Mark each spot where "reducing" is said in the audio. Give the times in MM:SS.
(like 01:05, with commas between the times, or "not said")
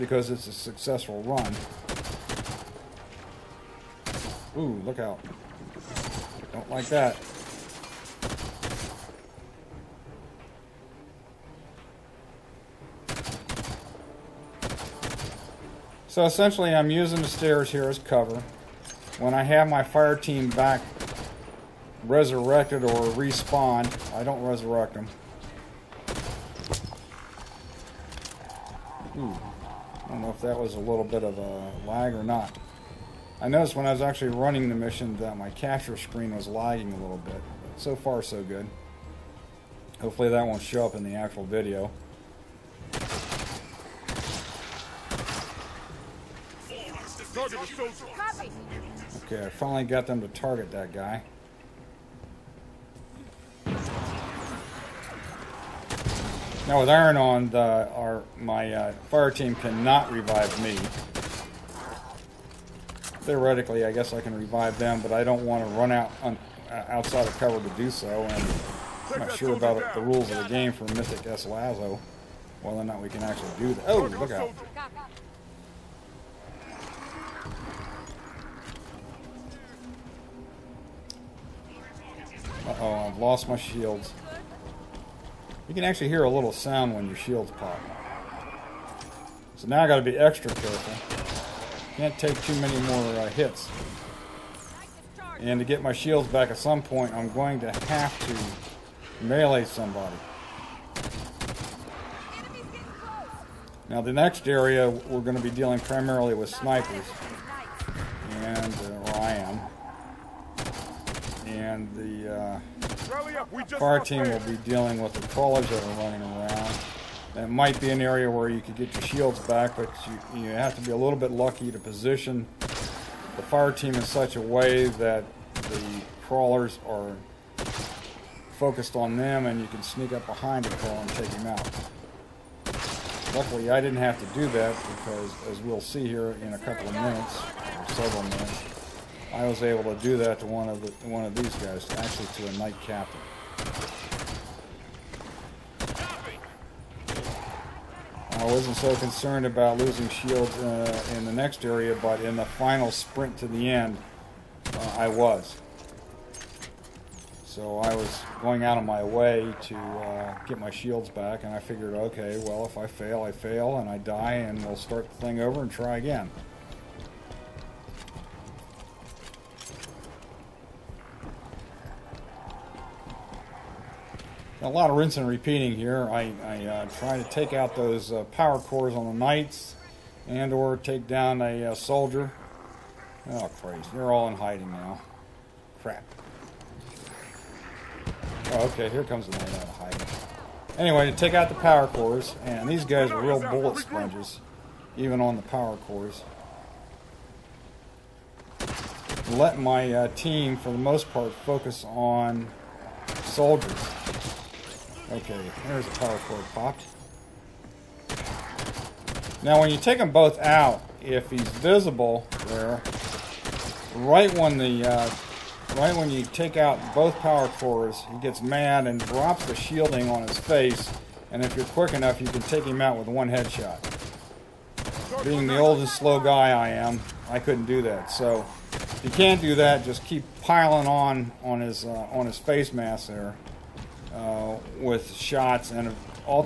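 not said.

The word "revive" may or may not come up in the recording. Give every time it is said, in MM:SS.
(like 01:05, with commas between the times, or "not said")
01:00, 01:04.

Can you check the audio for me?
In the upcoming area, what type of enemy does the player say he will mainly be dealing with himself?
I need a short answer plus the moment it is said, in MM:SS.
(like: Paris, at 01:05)
Snipers, at 01:46.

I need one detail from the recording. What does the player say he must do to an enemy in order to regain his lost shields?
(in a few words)
Melee somebody.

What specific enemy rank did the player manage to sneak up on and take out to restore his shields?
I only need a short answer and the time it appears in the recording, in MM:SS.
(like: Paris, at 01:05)
Knight captain, at 02:22.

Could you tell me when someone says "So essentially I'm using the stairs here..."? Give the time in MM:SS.
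00:16.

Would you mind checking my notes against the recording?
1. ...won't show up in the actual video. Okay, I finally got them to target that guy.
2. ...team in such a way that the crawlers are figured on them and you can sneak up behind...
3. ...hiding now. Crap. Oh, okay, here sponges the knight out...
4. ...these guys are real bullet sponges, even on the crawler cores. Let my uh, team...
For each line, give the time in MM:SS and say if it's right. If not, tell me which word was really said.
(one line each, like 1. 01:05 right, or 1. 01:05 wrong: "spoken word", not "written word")
1. 00:40 right
2. 02:03 wrong: "focused", not "figured"
3. 03:04 wrong: "comes", not "sponges"
4. 03:12 wrong: "power", not "crawler".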